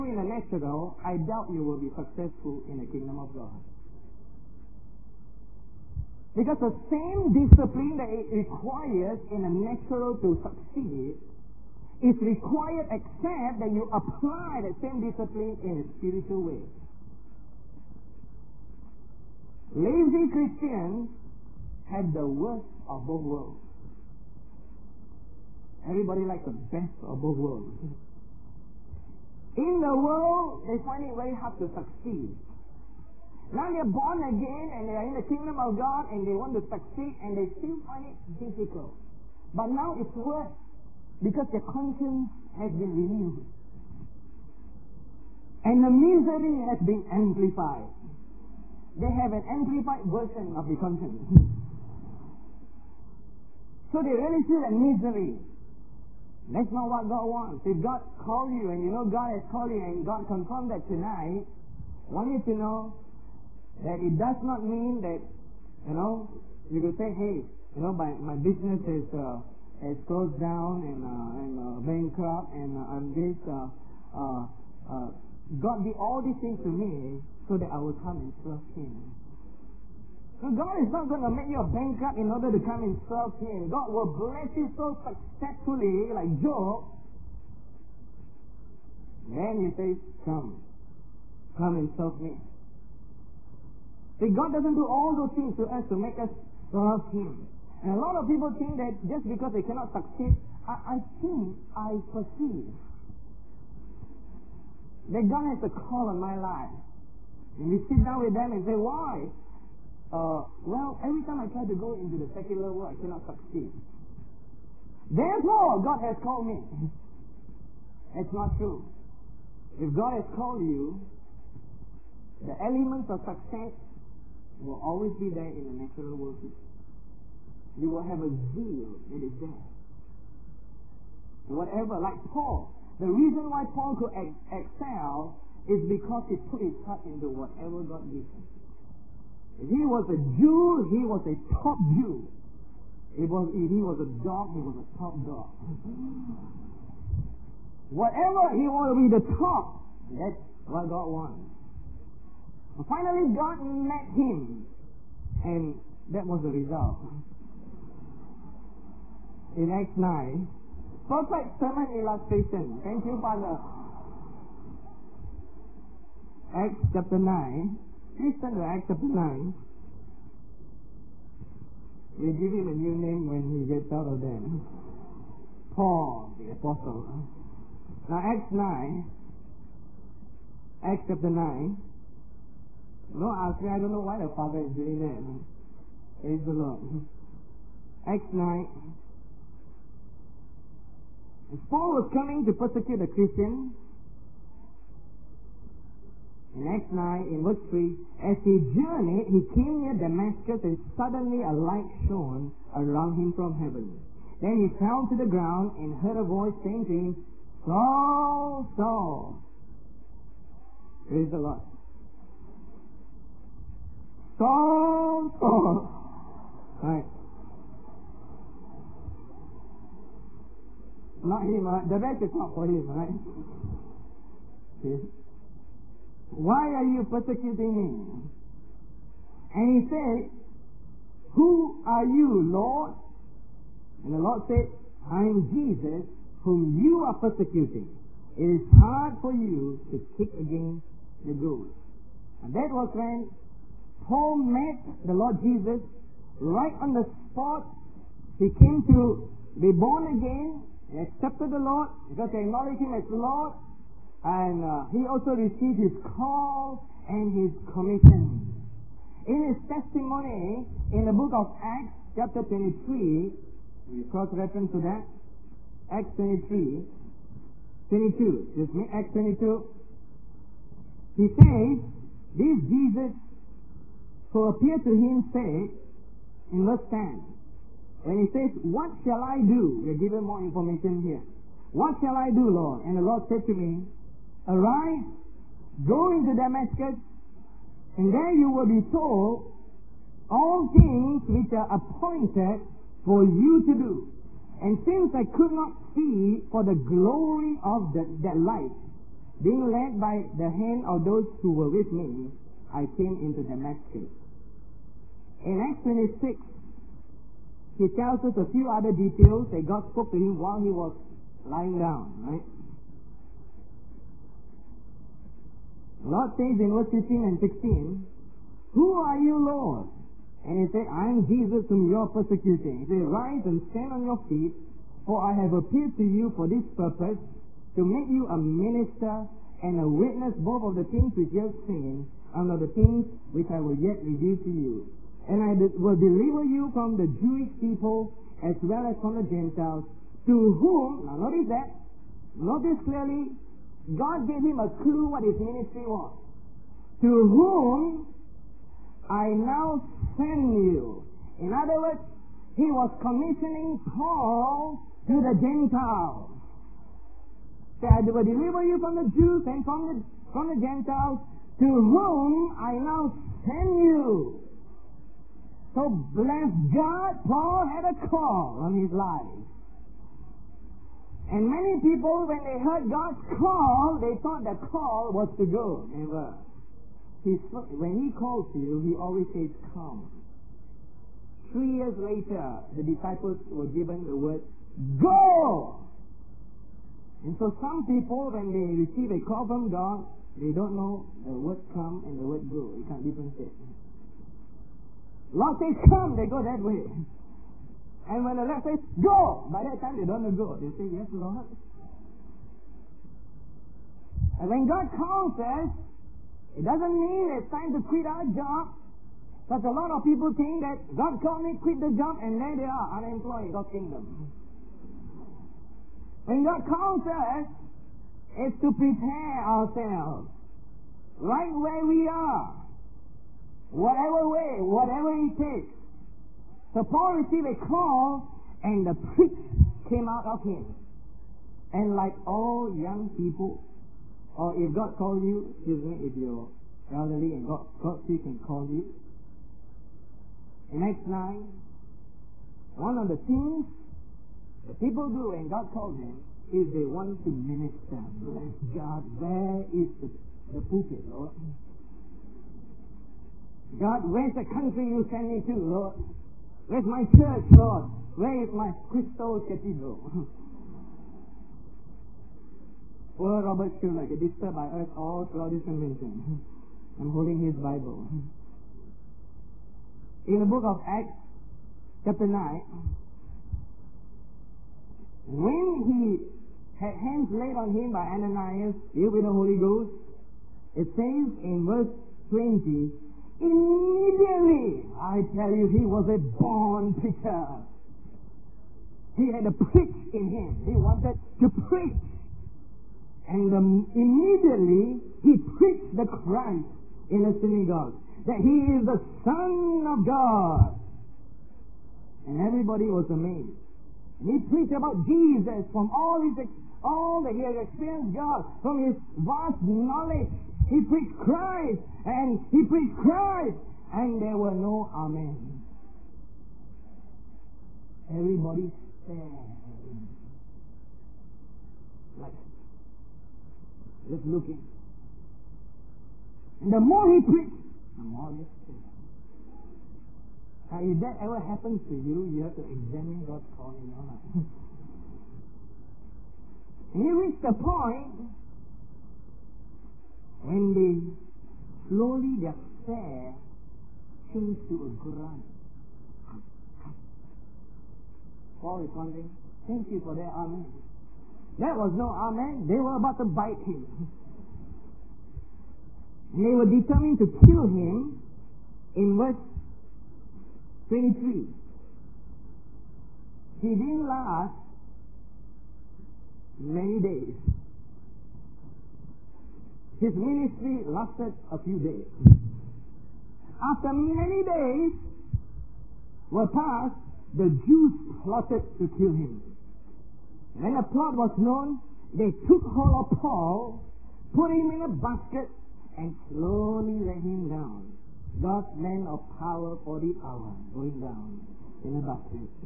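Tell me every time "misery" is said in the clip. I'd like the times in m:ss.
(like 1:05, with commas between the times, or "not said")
0:45, 0:54.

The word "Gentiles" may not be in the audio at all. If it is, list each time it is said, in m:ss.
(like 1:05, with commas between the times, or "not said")
5:39, 5:55, 6:00.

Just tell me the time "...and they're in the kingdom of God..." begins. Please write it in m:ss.
0:34.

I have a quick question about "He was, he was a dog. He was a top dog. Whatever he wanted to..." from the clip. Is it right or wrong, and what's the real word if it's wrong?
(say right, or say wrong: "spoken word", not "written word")
right.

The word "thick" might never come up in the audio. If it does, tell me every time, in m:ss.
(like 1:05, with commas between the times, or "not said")
not said.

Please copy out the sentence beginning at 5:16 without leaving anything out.
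Lord says in verse 15 and 16, Who are you, Lord?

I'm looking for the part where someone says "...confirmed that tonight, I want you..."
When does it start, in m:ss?
1:00.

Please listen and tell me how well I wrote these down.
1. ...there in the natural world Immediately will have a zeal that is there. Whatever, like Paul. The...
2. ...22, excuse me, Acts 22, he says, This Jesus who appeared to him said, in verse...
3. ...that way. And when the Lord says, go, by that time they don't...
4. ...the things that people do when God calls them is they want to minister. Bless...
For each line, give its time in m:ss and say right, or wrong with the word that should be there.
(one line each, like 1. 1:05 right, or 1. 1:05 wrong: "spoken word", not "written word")
1. 2:05 wrong: "You", not "Immediately"
2. 4:26 right
3. 6:36 right
4. 7:23 right.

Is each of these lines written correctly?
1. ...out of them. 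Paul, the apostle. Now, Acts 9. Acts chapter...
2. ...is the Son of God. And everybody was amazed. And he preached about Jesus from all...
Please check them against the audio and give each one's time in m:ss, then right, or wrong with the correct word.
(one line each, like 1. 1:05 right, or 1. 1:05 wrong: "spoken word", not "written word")
1. 2:53 right
2. 8:18 right.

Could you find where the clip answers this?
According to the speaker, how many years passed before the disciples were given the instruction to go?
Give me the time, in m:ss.
6:21.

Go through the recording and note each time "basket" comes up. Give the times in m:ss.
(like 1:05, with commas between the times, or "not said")
9:44, 9:52.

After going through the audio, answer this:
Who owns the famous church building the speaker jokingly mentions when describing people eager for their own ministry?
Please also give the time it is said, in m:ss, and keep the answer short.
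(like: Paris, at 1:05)
Robert Schuller, at 7:43.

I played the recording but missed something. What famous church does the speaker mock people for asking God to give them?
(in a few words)
Crystal Cathedral.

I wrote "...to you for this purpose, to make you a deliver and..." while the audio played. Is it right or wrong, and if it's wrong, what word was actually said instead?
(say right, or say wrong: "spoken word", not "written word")
wrong: "minister", not "deliver".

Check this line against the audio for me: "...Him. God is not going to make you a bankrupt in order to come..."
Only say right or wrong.
right.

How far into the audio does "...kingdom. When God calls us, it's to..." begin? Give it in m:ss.
6:53.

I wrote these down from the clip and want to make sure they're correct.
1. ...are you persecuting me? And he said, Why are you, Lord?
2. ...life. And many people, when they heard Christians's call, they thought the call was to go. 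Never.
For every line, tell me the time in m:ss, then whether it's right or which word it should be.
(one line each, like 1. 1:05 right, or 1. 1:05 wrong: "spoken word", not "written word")
1. 3:46 wrong: "Who", not "Why"
2. 6:08 wrong: "God", not "Christians".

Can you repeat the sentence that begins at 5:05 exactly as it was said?
In Acts 26, he tells us a few other details that God spoke to him while he was lying down, right?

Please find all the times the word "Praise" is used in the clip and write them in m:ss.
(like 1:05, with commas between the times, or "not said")
3:06, 3:31.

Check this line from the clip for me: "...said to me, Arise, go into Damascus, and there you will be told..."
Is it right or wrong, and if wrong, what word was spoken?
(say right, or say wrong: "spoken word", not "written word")
right.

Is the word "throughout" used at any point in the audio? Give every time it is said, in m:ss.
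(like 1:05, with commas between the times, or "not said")
7:45.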